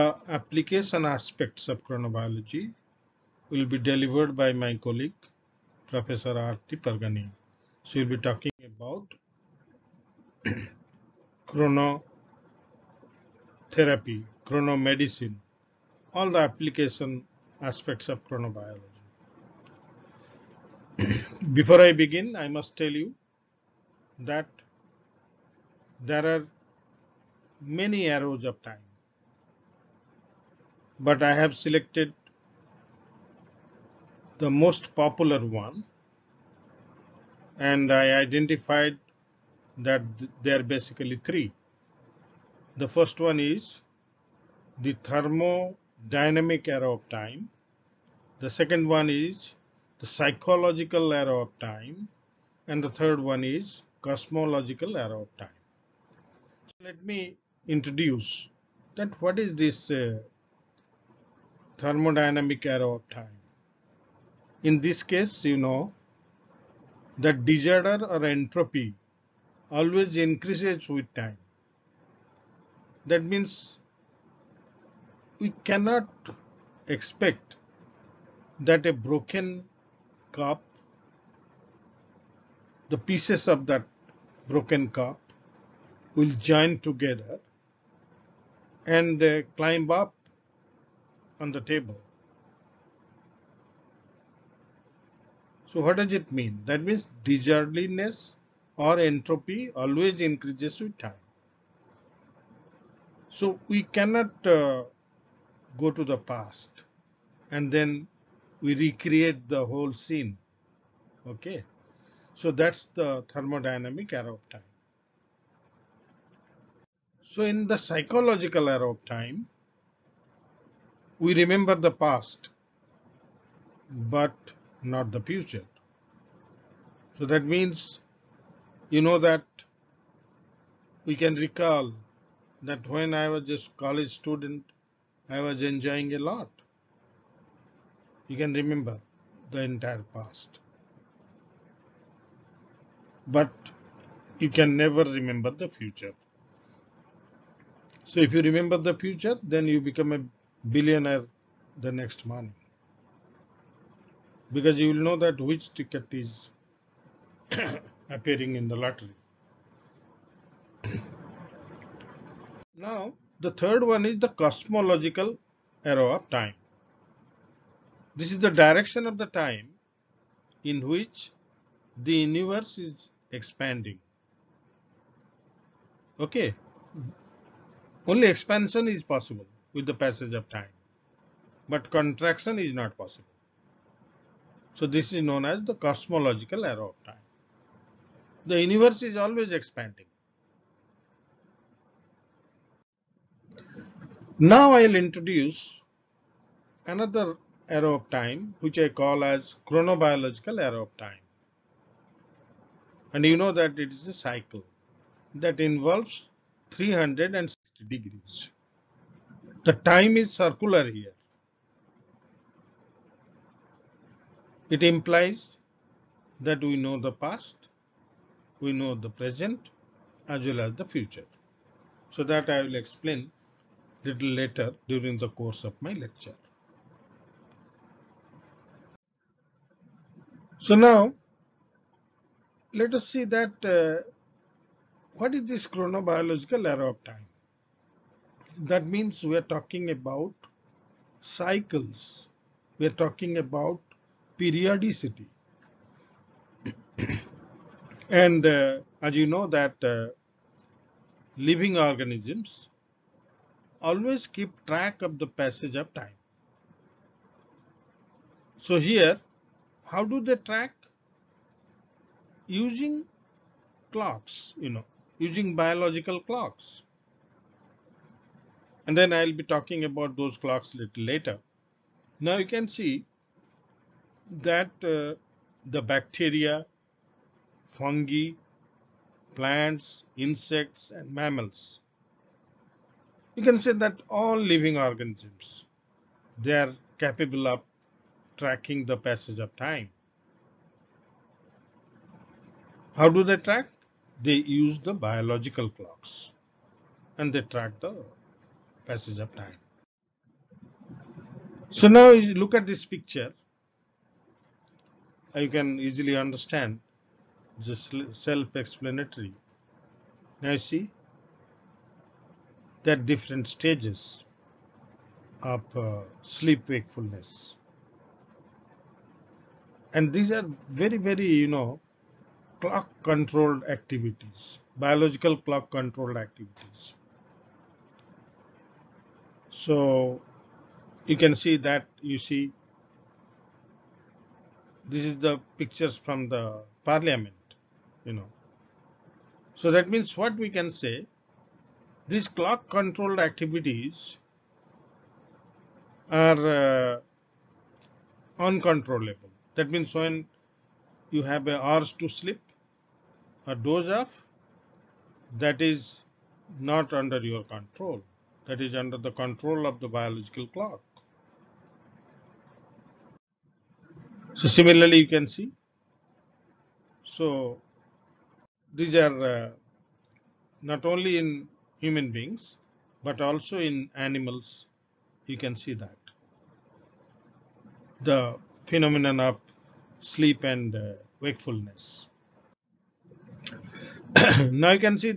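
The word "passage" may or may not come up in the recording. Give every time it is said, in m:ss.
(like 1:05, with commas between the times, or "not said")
2:59, 4:15, 4:48, 4:58.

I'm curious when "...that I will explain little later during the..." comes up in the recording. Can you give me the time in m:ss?
3:42.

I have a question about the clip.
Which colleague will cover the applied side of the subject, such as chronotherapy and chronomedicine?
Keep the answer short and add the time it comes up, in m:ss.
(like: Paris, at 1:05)
Professor Arti Parganiha, at 0:05.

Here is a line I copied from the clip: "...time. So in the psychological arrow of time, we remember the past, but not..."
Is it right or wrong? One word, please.
right.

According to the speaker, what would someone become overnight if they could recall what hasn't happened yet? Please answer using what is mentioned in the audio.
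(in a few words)
A billionaire.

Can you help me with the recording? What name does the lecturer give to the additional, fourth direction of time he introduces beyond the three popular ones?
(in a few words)
Chronobiological arrow of time.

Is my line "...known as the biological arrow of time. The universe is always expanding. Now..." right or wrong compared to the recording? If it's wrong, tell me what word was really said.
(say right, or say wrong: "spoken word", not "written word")
wrong: "cosmological", not "biological".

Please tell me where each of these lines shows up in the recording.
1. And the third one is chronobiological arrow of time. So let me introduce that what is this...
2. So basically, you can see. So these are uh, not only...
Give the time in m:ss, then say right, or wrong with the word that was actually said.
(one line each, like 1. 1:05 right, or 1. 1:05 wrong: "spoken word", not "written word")
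1. 0:52 wrong: "cosmological", not "chronobiological"
2. 6:04 wrong: "similarly", not "basically".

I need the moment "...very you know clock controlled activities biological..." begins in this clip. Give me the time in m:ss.
5:21.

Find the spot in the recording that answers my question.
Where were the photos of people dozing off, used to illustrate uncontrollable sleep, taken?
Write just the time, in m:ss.
5:36.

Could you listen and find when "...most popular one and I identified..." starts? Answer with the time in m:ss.
0:34.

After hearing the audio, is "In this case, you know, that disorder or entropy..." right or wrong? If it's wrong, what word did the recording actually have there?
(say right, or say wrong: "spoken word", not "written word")
right.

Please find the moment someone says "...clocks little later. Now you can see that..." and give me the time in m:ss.
4:30.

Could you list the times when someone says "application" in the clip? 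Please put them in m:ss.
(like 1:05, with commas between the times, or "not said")
0:00, 0:16.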